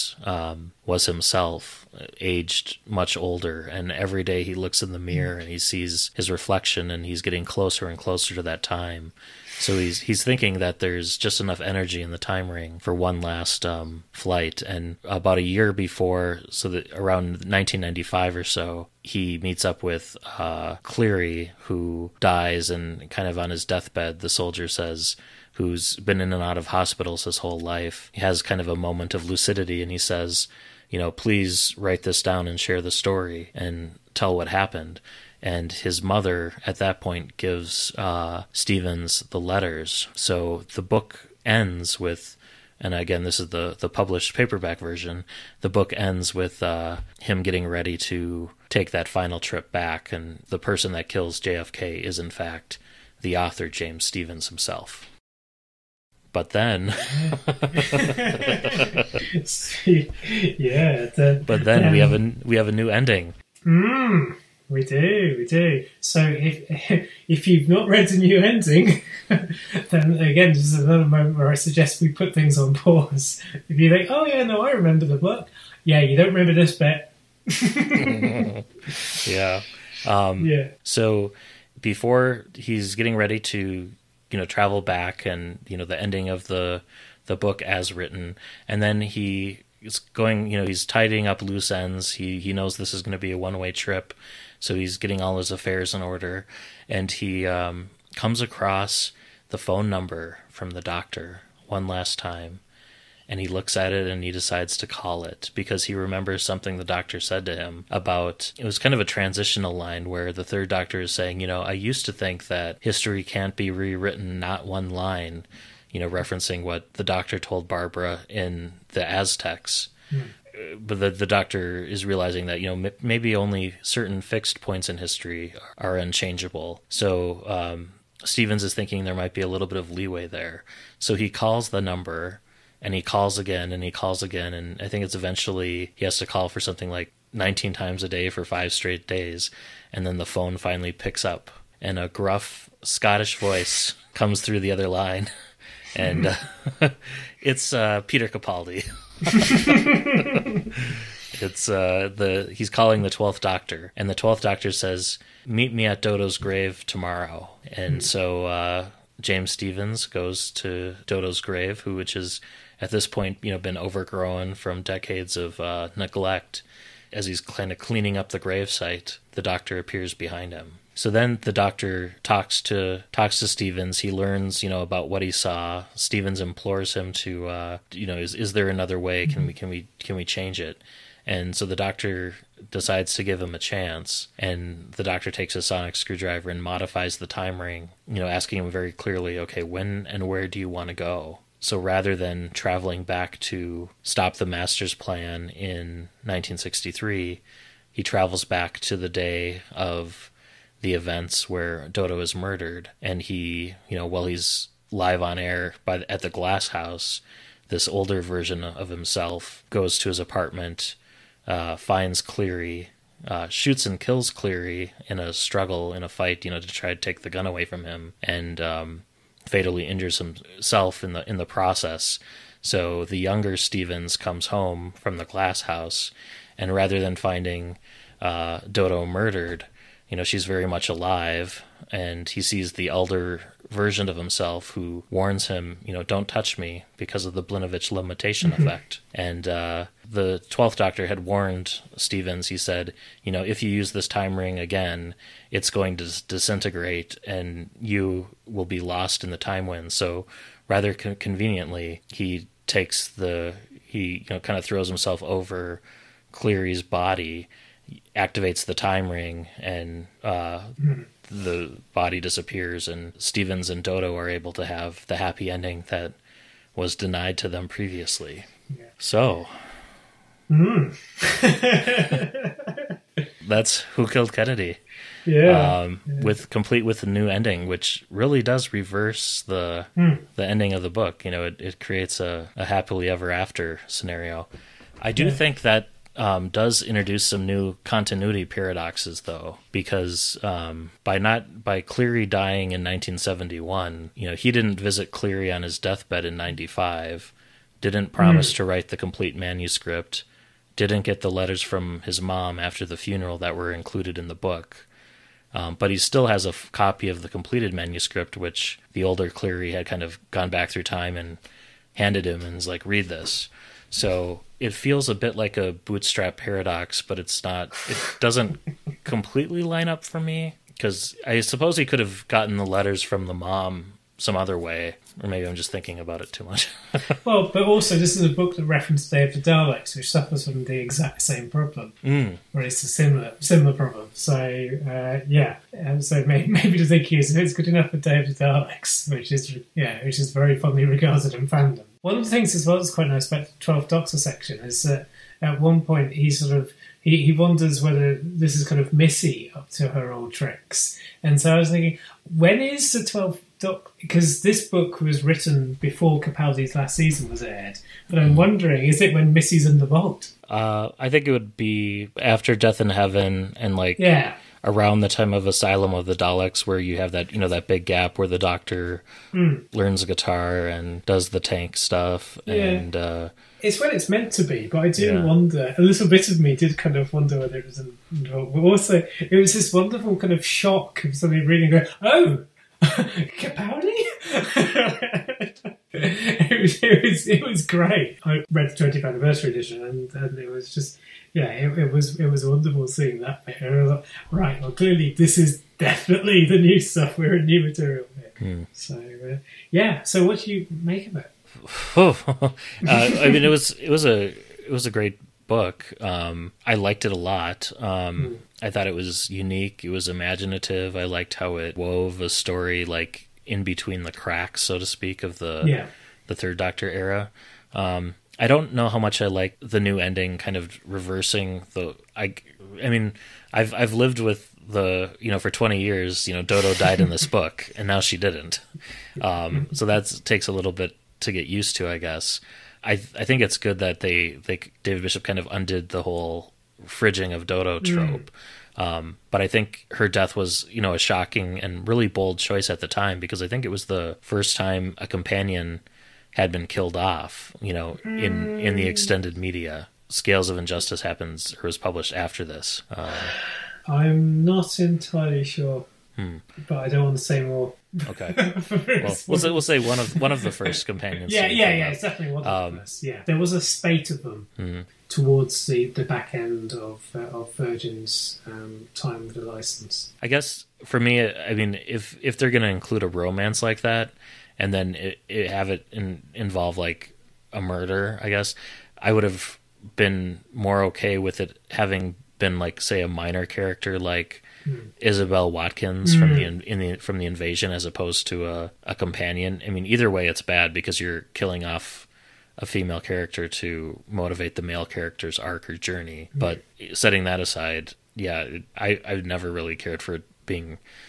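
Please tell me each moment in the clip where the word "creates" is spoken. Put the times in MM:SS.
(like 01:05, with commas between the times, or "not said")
04:41.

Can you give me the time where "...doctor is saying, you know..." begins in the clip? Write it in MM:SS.
01:50.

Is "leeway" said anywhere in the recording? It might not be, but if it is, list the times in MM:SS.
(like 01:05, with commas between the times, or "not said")
02:09.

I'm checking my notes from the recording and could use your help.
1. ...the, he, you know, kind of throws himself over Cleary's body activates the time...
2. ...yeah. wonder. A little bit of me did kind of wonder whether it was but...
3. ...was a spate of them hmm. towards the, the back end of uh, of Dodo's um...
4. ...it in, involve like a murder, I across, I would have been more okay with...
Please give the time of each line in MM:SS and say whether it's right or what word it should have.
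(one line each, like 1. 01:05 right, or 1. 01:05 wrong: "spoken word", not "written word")
1. 04:13 right
2. 06:15 right
3. 07:43 wrong: "Virgin", not "Dodo"
4. 07:55 wrong: "guess", not "across".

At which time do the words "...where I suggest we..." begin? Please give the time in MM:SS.
01:11.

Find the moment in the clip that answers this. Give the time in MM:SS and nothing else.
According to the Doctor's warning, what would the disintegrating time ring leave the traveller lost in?
04:09.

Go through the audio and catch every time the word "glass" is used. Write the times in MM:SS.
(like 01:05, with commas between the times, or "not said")
03:26, 03:45.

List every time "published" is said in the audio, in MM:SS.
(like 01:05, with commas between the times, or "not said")
00:43, 07:31.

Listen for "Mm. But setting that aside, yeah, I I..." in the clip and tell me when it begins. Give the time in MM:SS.
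08:16.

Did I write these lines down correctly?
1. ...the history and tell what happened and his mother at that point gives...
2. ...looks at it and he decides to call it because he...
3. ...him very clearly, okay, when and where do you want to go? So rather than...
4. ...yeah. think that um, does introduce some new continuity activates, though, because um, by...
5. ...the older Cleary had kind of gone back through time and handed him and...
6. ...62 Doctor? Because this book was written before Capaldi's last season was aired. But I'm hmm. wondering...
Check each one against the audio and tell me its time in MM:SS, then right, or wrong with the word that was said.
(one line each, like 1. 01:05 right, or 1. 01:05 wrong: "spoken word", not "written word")
1. 00:32 wrong: "story", not "history"
2. 01:43 right
3. 03:08 right
4. 04:45 wrong: "paradoxes", not "activates"
5. 05:08 right
6. 05:53 wrong: "12", not "62".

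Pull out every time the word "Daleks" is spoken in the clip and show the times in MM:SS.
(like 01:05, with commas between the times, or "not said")
05:29, 05:38, 06:06.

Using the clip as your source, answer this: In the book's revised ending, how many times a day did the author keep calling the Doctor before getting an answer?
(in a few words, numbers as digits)
19.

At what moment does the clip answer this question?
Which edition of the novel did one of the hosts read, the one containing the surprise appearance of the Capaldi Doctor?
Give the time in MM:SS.
06:28.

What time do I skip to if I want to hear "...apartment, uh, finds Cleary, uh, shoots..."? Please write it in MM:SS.
03:30.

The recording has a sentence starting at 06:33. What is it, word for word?
Like, right, well, clearly this is definitely the new stuff.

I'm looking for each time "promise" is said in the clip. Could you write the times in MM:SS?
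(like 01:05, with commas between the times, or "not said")
04:58.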